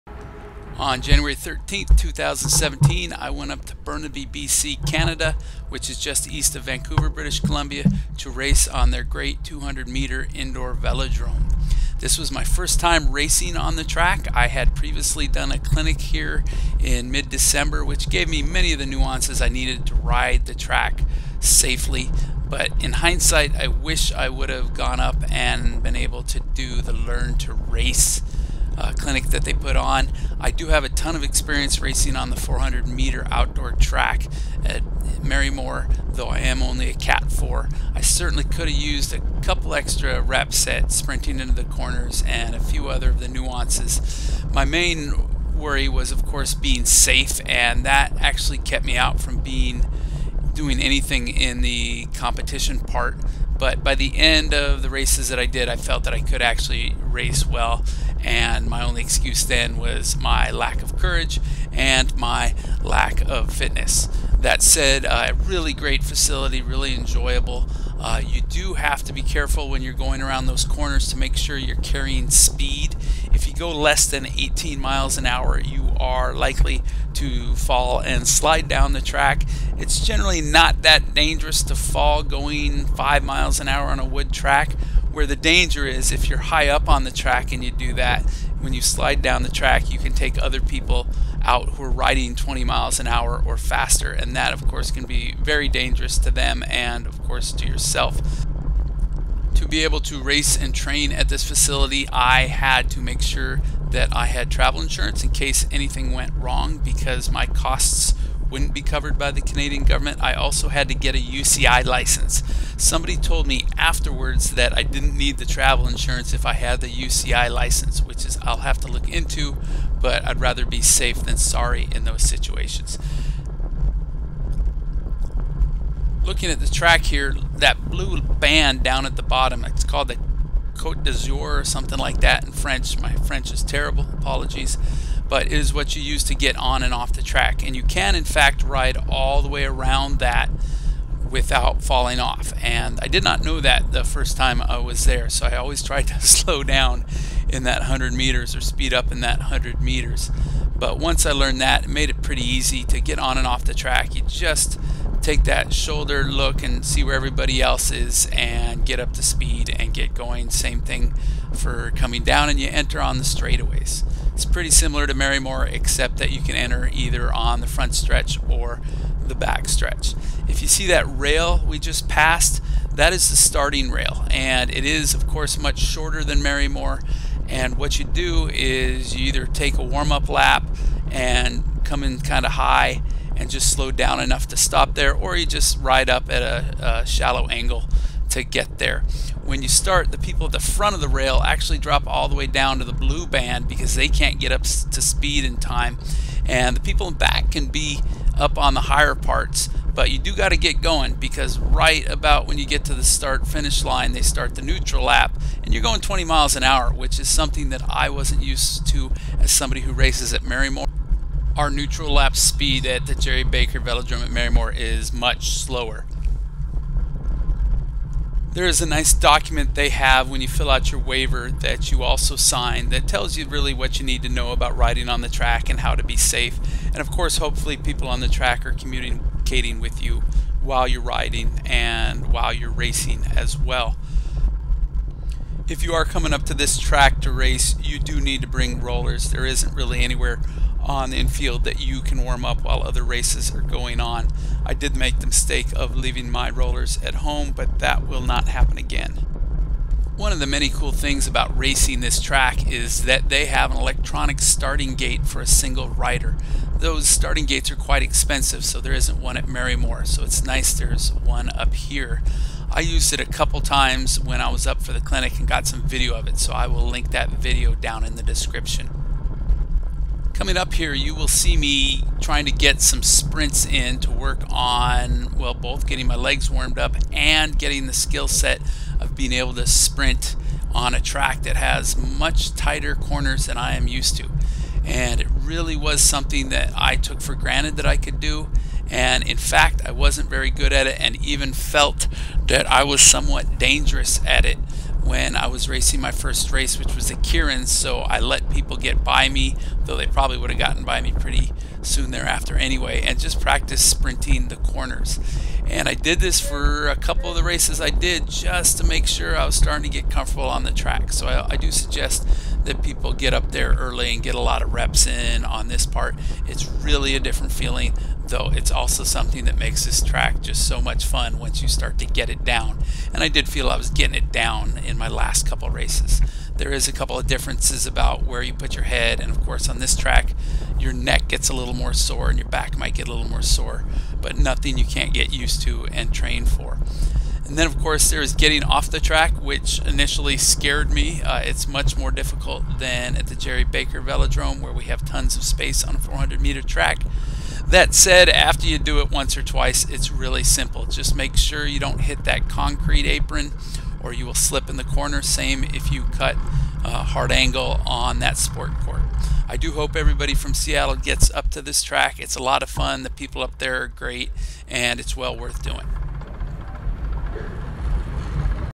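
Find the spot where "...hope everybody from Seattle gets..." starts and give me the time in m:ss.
5:59.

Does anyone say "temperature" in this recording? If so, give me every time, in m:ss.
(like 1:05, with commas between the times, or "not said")
not said.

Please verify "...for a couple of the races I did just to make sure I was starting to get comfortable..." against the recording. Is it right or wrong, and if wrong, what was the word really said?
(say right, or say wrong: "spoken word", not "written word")
right.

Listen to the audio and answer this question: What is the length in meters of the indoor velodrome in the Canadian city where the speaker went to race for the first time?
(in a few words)
200.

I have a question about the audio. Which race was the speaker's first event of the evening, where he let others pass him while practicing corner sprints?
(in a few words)
Keirin.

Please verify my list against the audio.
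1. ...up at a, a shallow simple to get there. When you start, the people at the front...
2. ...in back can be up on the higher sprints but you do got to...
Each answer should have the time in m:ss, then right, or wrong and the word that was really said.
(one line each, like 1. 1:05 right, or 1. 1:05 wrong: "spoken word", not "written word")
1. 3:06 wrong: "angle", not "simple"
2. 3:17 wrong: "parts", not "sprints".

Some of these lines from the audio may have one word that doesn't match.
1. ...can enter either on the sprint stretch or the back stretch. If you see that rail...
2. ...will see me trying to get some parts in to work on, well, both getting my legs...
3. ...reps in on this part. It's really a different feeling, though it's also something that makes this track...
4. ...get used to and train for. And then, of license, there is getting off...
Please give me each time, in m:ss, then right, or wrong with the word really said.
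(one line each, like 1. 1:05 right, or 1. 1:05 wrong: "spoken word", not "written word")
1. 2:46 wrong: "front", not "sprint"
2. 4:31 wrong: "sprints", not "parts"
3. 5:14 right
4. 5:35 wrong: "course", not "license".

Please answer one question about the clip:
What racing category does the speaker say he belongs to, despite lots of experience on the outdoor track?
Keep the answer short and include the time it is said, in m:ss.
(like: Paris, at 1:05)
Cat 4, at 0:36.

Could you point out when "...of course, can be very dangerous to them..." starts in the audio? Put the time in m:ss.
1:34.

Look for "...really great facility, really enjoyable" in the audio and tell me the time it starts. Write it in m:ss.
1:05.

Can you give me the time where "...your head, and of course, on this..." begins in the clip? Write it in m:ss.
5:28.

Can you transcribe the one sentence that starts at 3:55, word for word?
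If you are coming up to this track to race, you do need to bring rollers.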